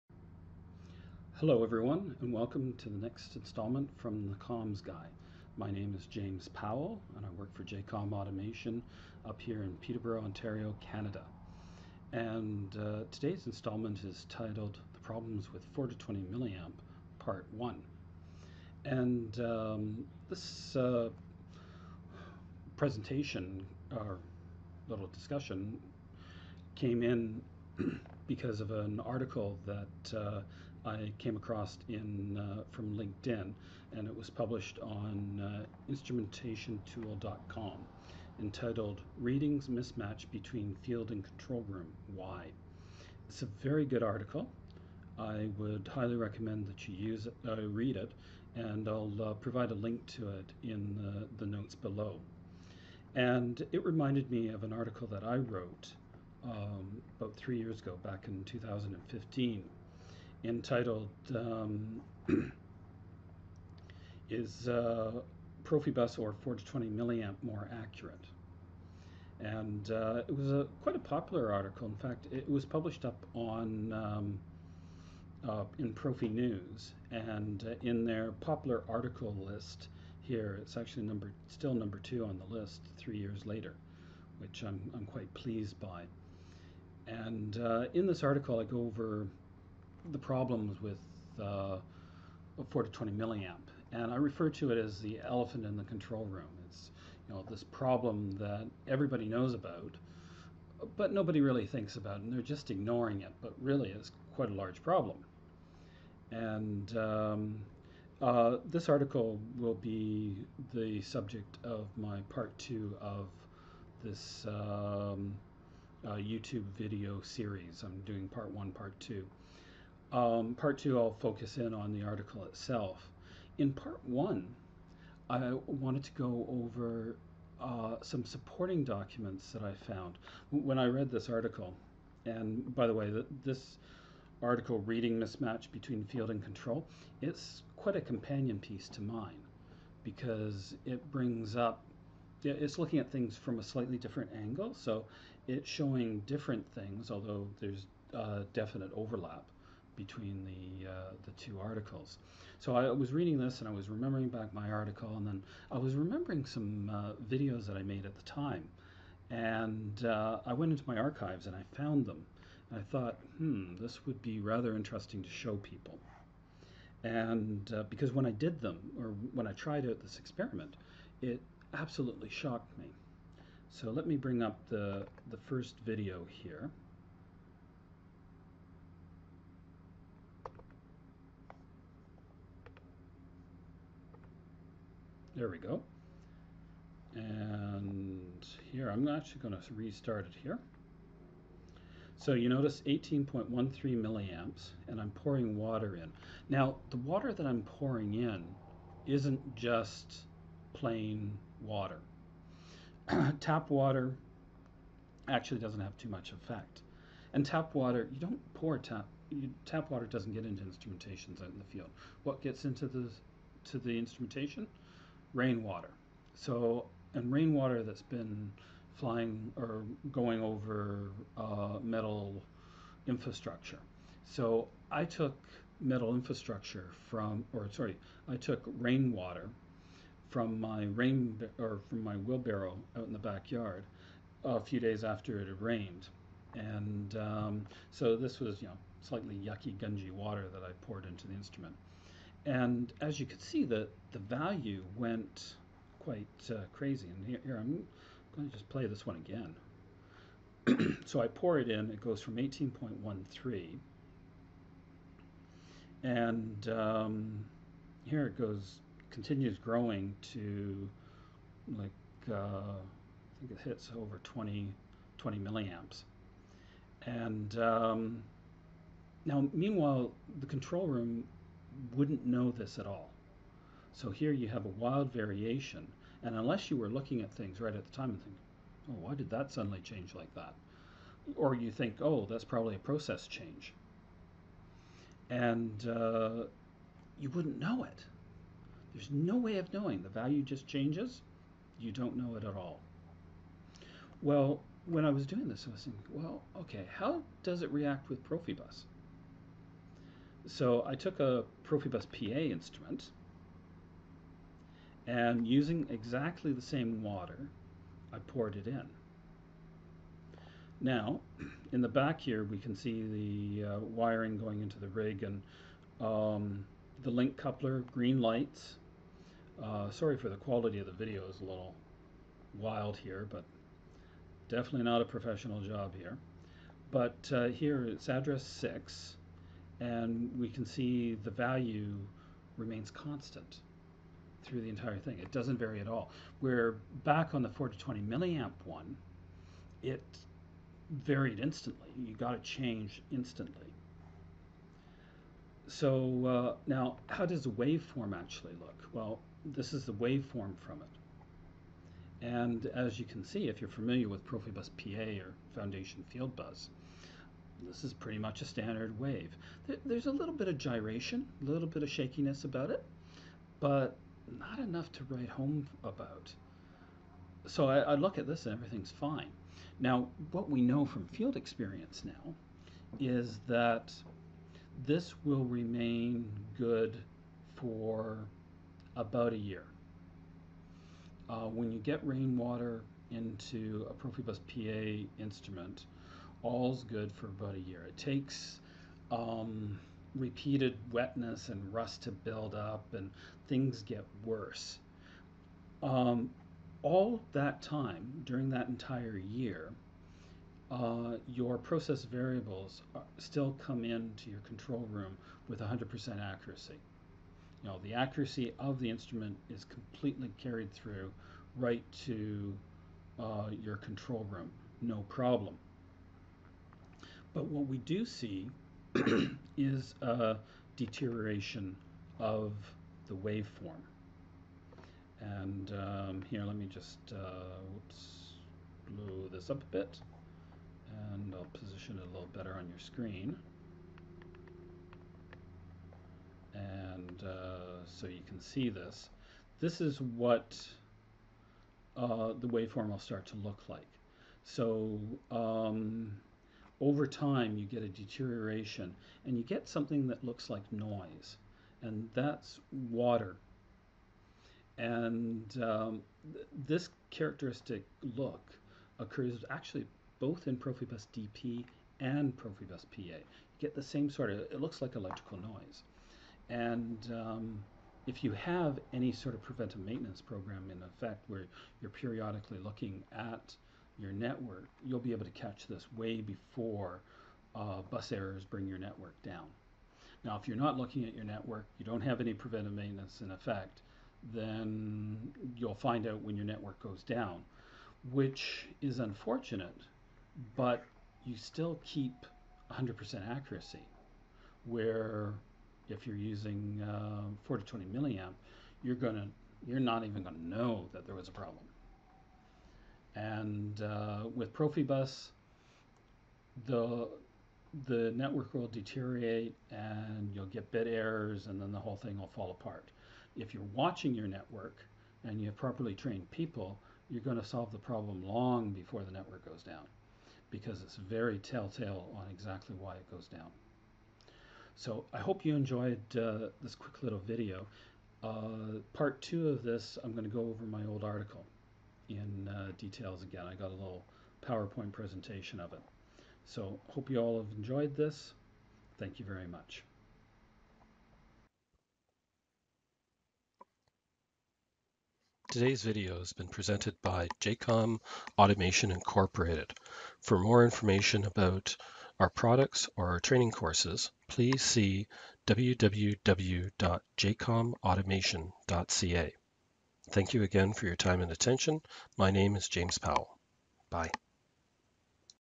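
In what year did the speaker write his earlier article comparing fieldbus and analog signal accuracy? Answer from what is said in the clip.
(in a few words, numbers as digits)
2015.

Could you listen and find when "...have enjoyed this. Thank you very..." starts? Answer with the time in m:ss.
8:57.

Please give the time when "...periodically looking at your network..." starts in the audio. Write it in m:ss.
7:52.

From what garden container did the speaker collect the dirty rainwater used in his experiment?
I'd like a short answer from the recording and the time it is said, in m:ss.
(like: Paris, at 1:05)
wheelbarrow, at 3:52.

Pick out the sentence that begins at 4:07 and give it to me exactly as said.
And here, here I'm going to just play this one again.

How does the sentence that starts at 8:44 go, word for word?
So I hope you enjoyed uh, this quick little video.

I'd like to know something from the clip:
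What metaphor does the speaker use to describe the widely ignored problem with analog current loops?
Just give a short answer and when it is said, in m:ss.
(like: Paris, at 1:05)
the elephant in the control room, at 1:35.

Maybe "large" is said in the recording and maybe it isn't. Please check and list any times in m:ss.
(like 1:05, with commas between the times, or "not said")
1:44.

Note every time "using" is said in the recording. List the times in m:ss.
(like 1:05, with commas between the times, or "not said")
5:05, 8:16.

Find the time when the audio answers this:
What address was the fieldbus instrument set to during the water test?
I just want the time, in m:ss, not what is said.
5:28.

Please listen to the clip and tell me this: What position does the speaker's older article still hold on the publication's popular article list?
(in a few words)
number two.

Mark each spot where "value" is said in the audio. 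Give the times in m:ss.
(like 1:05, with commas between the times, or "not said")
4:04, 4:50, 5:31.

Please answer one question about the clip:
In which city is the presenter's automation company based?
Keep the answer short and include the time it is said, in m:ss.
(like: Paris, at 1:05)
Peterborough, at 0:09.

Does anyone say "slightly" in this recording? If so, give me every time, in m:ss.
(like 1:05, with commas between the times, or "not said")
2:23, 3:59.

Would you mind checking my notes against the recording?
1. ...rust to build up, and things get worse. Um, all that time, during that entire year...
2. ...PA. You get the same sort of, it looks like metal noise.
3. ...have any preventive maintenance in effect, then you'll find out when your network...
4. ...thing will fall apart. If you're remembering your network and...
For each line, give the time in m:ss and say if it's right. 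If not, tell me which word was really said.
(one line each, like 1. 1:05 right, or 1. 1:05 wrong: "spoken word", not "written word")
1. 6:31 right
2. 7:42 wrong: "electrical", not "metal"
3. 8:02 right
4. 8:31 wrong: "watching", not "remembering".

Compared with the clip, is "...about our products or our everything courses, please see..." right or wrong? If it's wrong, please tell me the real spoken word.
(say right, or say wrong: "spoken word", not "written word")
wrong: "training", not "everything".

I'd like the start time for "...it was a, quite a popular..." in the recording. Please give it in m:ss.
1:10.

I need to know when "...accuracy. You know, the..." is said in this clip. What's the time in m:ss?
6:46.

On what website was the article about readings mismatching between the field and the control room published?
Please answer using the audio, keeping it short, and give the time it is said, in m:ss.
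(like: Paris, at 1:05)
instrumentationtool.com, at 0:35.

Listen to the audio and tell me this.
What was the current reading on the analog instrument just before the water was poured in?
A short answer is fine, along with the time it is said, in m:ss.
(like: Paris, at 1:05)
18.13 milliamps, at 3:12.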